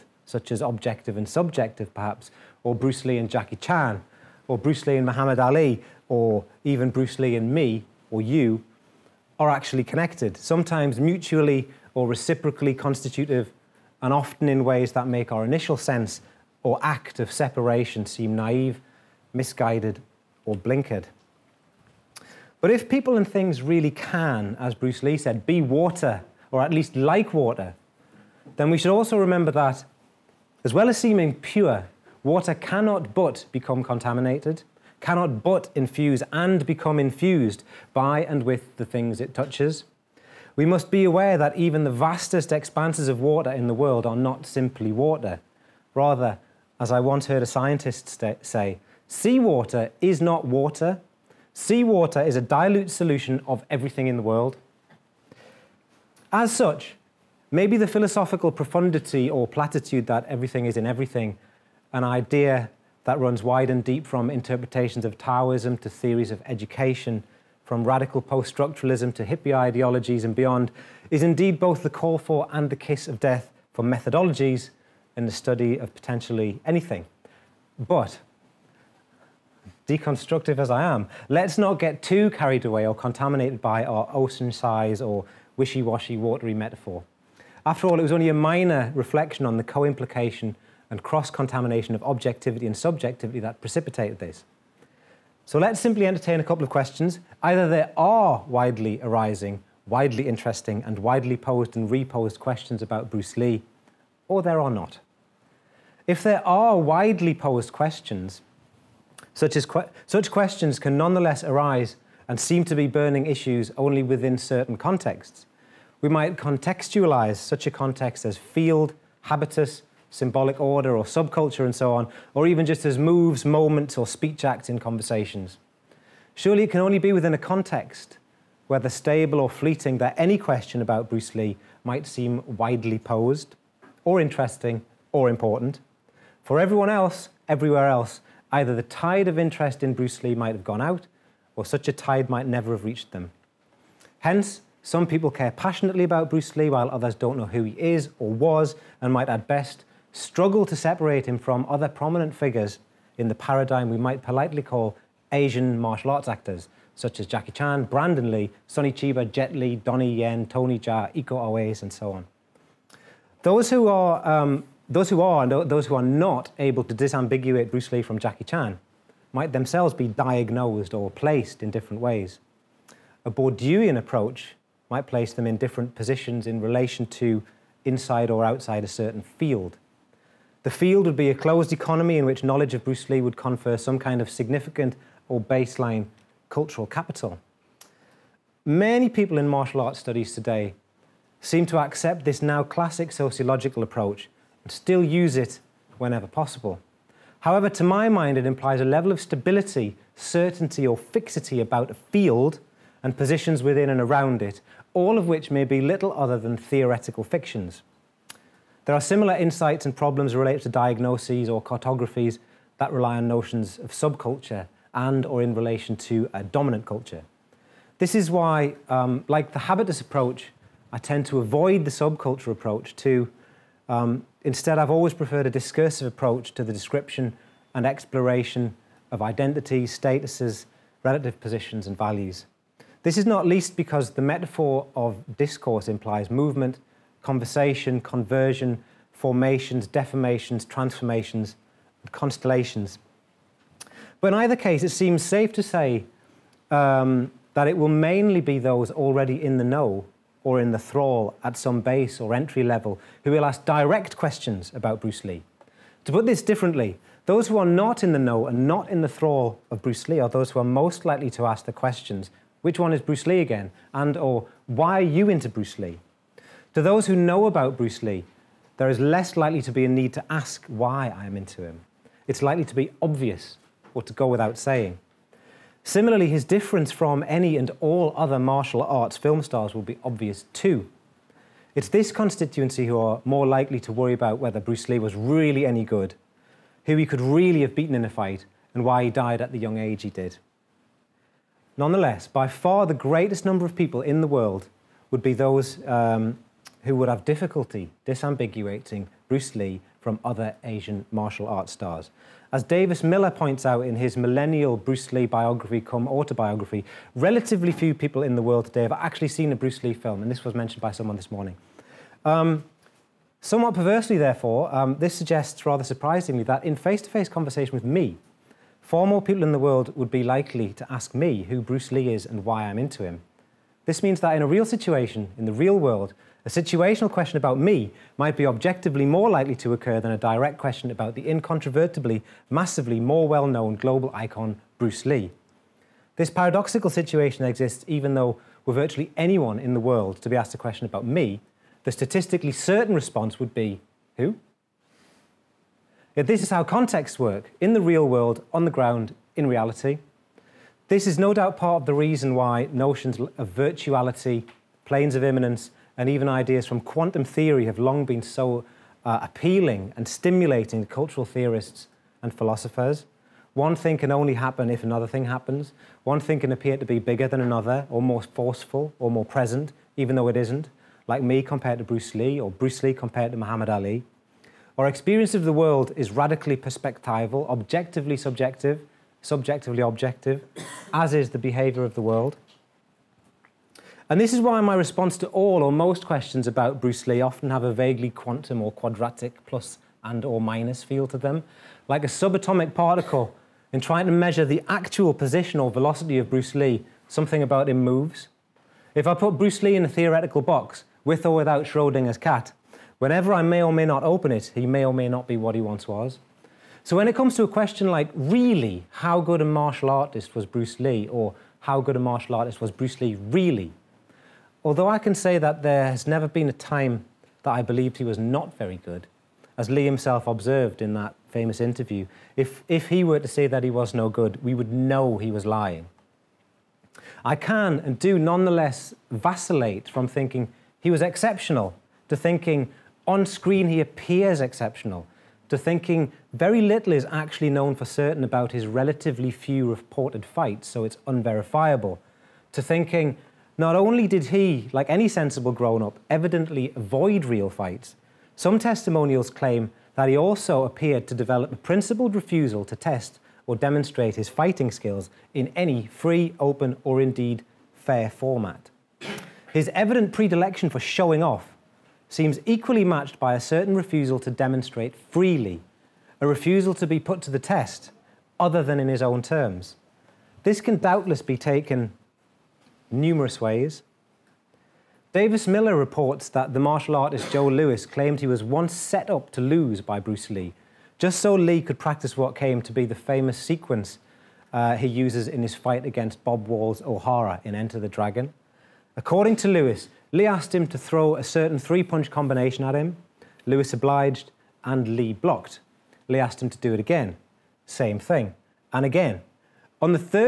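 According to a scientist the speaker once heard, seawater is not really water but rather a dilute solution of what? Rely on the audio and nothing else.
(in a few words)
everything in the world.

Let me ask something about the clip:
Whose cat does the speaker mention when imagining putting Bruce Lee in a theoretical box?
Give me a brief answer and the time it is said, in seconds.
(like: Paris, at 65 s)
Schrodinger, at 401 s.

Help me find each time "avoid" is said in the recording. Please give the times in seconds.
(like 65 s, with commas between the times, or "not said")
221 s, 446 s.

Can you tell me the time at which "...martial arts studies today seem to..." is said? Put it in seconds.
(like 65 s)
189 s.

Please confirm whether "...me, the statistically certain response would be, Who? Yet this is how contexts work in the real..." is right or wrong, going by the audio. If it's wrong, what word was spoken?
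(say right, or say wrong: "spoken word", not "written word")
right.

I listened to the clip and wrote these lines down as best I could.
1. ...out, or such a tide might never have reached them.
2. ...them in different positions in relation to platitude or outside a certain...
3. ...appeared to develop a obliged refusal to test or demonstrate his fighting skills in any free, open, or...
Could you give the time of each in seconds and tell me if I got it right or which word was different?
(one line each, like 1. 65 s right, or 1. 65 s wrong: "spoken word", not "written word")
1. 140 s right
2. 175 s wrong: "inside", not "platitude"
3. 450 s wrong: "principled", not "obliged".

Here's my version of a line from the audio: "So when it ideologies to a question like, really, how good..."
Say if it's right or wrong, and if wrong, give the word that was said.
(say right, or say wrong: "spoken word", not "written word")
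wrong: "comes", not "ideologies".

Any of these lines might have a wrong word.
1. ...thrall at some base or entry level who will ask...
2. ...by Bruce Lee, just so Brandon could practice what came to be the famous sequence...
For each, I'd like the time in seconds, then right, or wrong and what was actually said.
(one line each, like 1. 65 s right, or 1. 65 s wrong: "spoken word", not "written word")
1. 250 s right
2. 479 s wrong: "Lee", not "Brandon".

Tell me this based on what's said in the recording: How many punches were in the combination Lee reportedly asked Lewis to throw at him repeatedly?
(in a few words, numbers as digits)
3.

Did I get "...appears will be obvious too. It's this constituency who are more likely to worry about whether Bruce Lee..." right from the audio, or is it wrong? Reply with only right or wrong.
wrong.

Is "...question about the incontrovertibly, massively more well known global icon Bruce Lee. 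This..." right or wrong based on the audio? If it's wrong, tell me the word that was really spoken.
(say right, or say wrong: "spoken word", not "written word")
right.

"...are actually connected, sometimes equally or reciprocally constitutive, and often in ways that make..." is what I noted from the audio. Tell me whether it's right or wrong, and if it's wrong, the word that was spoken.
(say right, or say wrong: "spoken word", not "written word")
wrong: "mutually", not "equally".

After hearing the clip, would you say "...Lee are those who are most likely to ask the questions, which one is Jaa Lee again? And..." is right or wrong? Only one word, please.
wrong.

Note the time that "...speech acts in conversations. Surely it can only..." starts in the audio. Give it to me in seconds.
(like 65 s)
124 s.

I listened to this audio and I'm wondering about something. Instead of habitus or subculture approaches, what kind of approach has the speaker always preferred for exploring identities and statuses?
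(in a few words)
a discursive approach.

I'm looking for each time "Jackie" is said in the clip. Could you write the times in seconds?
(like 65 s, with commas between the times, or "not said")
3 s, 157 s, 168 s.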